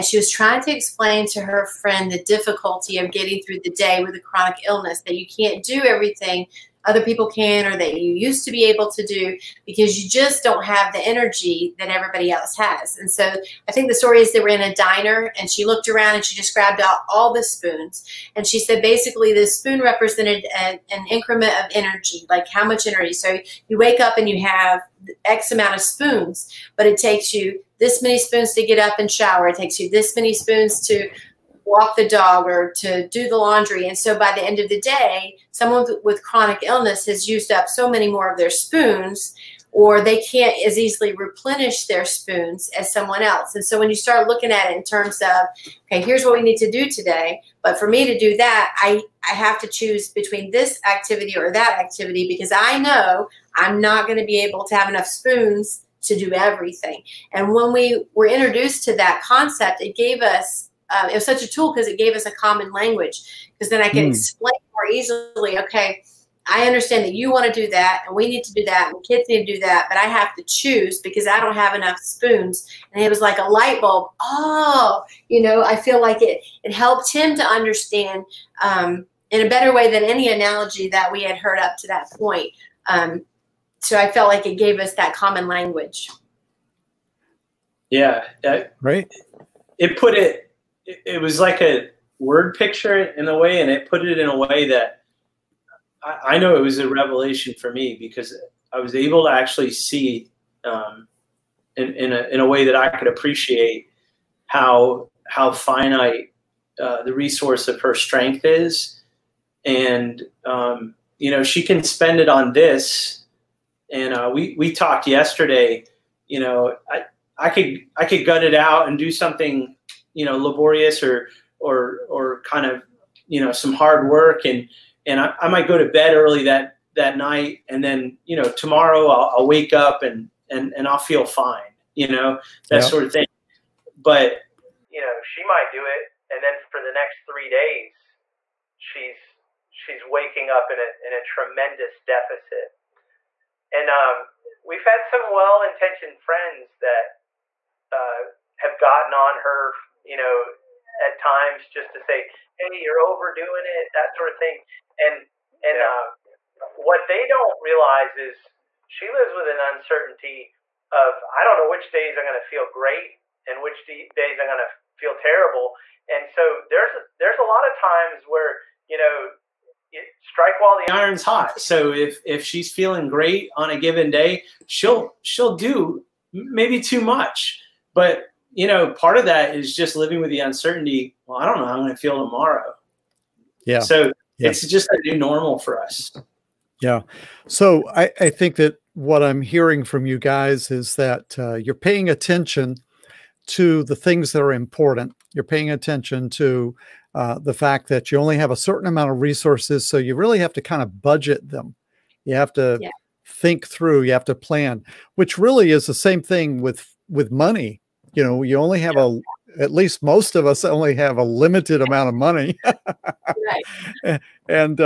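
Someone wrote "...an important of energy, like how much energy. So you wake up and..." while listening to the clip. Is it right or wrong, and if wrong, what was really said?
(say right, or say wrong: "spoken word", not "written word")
wrong: "increment", not "important".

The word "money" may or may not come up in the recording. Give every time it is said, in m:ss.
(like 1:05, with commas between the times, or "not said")
3:27, 3:32.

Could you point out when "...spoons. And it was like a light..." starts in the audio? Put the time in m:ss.
1:11.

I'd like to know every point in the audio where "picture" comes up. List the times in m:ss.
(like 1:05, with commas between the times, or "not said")
1:32.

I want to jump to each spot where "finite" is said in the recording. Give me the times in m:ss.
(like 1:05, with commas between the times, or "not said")
1:45.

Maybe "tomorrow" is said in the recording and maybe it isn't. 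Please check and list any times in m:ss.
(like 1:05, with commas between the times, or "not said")
2:08, 3:02.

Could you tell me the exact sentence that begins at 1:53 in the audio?
And uh, we we talked yesterday.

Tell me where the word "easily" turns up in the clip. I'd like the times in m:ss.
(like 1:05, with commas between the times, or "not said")
0:40, 1:04.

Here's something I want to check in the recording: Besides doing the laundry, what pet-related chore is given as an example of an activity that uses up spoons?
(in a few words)
walk the dog.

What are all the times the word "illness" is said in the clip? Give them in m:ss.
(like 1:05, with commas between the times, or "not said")
0:04, 0:36.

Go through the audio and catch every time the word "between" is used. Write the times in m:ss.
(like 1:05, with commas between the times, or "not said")
0:50.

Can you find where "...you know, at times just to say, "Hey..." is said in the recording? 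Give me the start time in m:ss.
2:30.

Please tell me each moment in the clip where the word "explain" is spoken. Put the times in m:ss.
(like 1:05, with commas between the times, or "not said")
0:00, 1:04.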